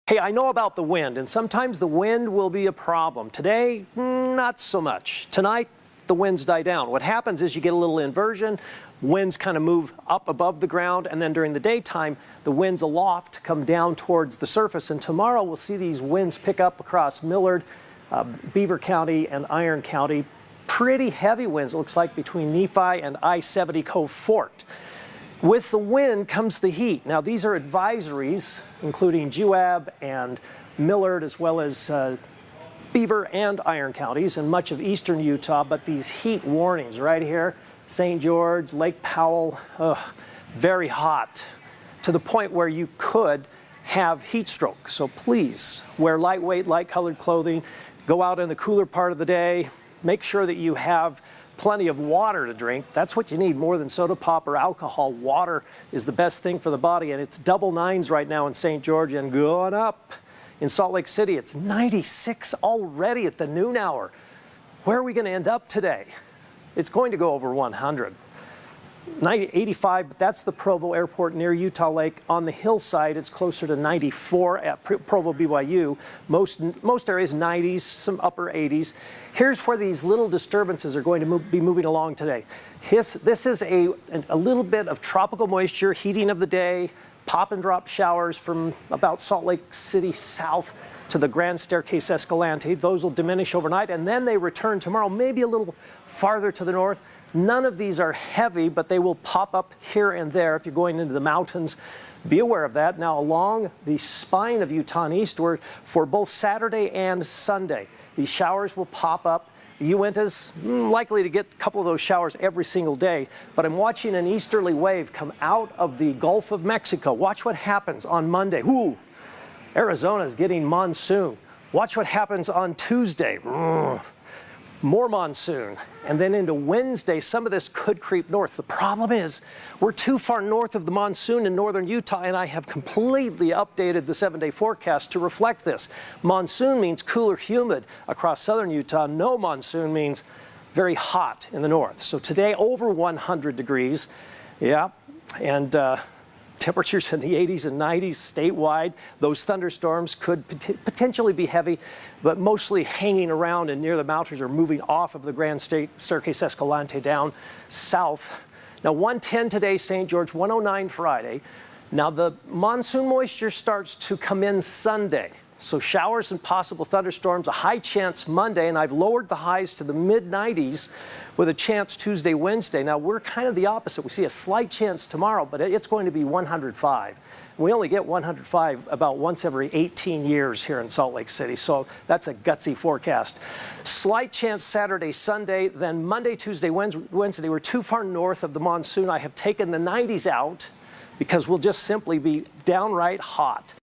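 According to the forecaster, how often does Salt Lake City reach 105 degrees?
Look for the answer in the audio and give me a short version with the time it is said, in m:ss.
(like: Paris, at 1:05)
Once every 18 years, at 2:59.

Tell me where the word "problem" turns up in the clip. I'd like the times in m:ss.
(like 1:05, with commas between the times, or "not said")
0:02, 2:08.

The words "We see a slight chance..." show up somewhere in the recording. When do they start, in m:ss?
2:54.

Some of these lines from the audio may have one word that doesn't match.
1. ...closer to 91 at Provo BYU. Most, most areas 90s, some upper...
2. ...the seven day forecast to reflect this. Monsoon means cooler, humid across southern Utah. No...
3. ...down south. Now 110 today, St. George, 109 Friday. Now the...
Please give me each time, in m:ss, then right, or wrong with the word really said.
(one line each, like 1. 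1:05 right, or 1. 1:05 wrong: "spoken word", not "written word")
1. 1:13 wrong: "94", not "91"
2. 2:14 right
3. 2:37 right.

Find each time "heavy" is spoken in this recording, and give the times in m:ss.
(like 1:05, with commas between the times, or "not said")
0:21, 1:38, 2:31.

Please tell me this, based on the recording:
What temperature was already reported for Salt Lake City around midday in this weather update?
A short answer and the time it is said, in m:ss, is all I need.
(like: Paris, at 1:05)
96, at 1:01.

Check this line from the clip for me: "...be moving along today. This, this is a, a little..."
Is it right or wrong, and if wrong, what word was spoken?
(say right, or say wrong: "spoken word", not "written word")
right.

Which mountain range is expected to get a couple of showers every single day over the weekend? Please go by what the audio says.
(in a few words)
Uintas.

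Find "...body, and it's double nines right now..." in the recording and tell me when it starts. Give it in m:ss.
0:56.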